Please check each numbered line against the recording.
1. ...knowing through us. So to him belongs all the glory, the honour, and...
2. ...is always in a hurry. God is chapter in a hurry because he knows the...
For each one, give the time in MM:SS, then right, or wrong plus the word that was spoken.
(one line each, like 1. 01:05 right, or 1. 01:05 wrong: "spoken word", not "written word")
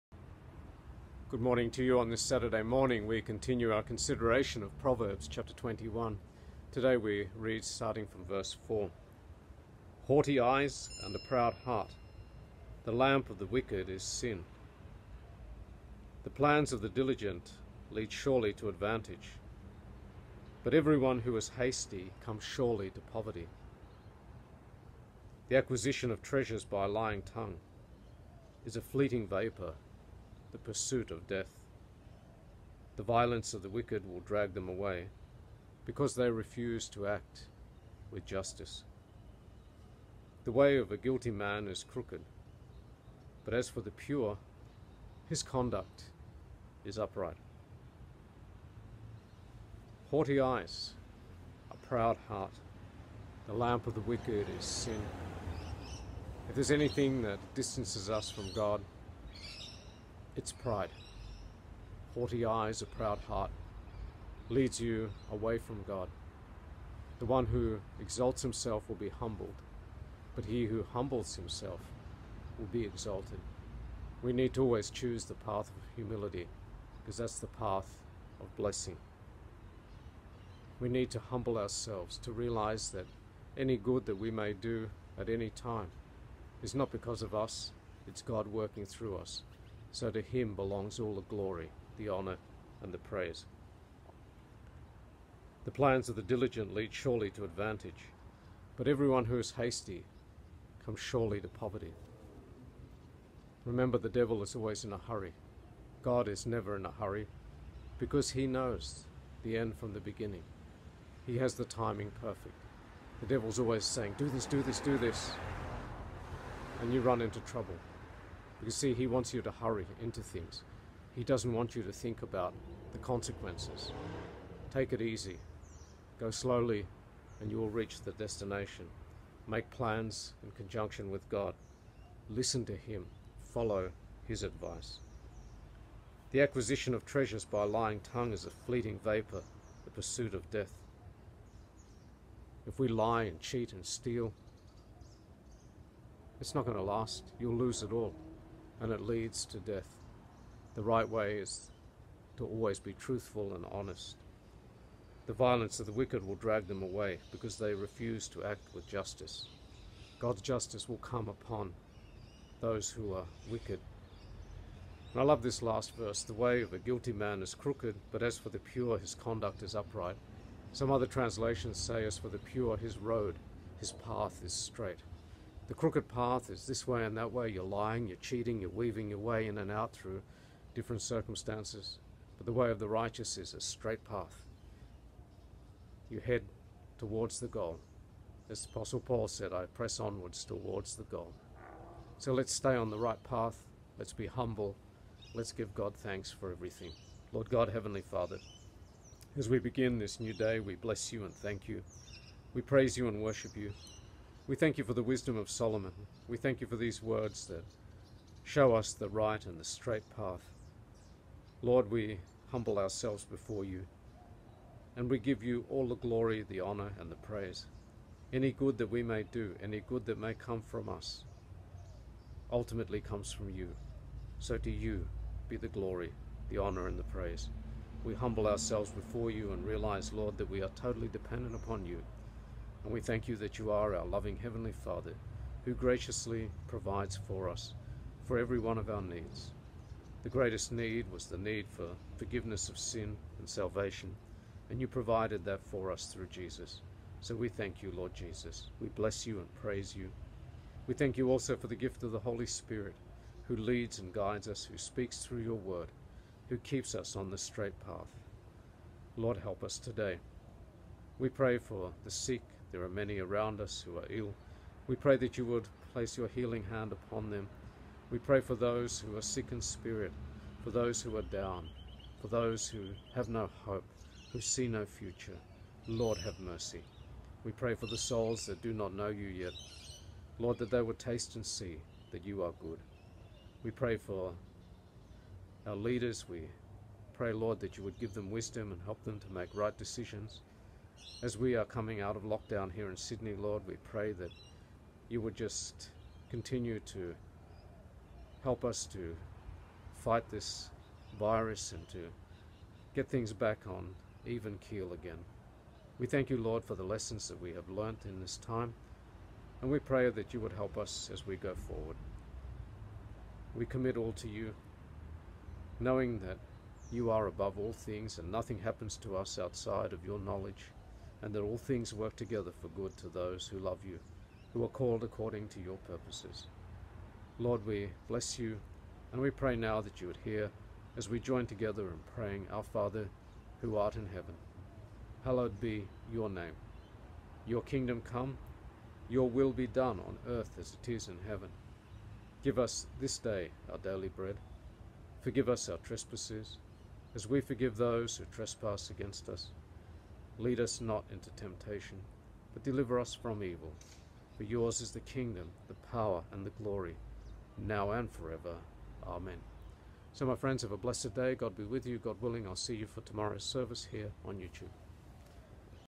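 1. 01:28 wrong: "working", not "knowing"
2. 01:44 wrong: "never", not "chapter".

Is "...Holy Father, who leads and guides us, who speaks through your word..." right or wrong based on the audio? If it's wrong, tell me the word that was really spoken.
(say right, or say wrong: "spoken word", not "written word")
wrong: "Spirit", not "Father".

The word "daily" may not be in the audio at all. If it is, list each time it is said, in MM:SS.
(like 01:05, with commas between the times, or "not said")
05:43.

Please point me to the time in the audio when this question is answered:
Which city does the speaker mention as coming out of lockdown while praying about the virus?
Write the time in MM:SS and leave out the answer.
04:52.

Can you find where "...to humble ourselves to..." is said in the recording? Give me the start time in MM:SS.
01:21.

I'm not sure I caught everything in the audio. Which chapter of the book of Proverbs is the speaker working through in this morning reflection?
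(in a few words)
21.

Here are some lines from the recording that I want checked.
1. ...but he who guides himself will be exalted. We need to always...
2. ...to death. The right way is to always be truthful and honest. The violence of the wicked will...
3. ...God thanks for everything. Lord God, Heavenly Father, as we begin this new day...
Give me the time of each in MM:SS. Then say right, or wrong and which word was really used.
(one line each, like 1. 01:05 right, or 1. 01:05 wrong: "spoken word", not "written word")
1. 01:10 wrong: "humbles", not "guides"
2. 02:29 right
3. 03:15 right.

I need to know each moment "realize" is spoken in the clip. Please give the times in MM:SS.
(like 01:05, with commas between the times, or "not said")
01:22, 03:49.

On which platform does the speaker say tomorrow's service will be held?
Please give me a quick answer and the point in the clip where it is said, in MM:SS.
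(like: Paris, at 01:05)
YouTube, at 06:04.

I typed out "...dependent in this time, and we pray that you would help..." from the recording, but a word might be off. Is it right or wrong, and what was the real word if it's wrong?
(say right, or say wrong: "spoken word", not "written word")
wrong: "learnt", not "dependent".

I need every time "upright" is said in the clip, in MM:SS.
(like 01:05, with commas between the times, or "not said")
00:46, 02:49.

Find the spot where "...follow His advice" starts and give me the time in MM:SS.
02:13.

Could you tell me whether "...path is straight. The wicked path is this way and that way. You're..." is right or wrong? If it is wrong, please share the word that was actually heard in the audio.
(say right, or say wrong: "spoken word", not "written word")
wrong: "crooked", not "wicked".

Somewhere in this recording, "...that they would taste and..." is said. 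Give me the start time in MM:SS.
04:40.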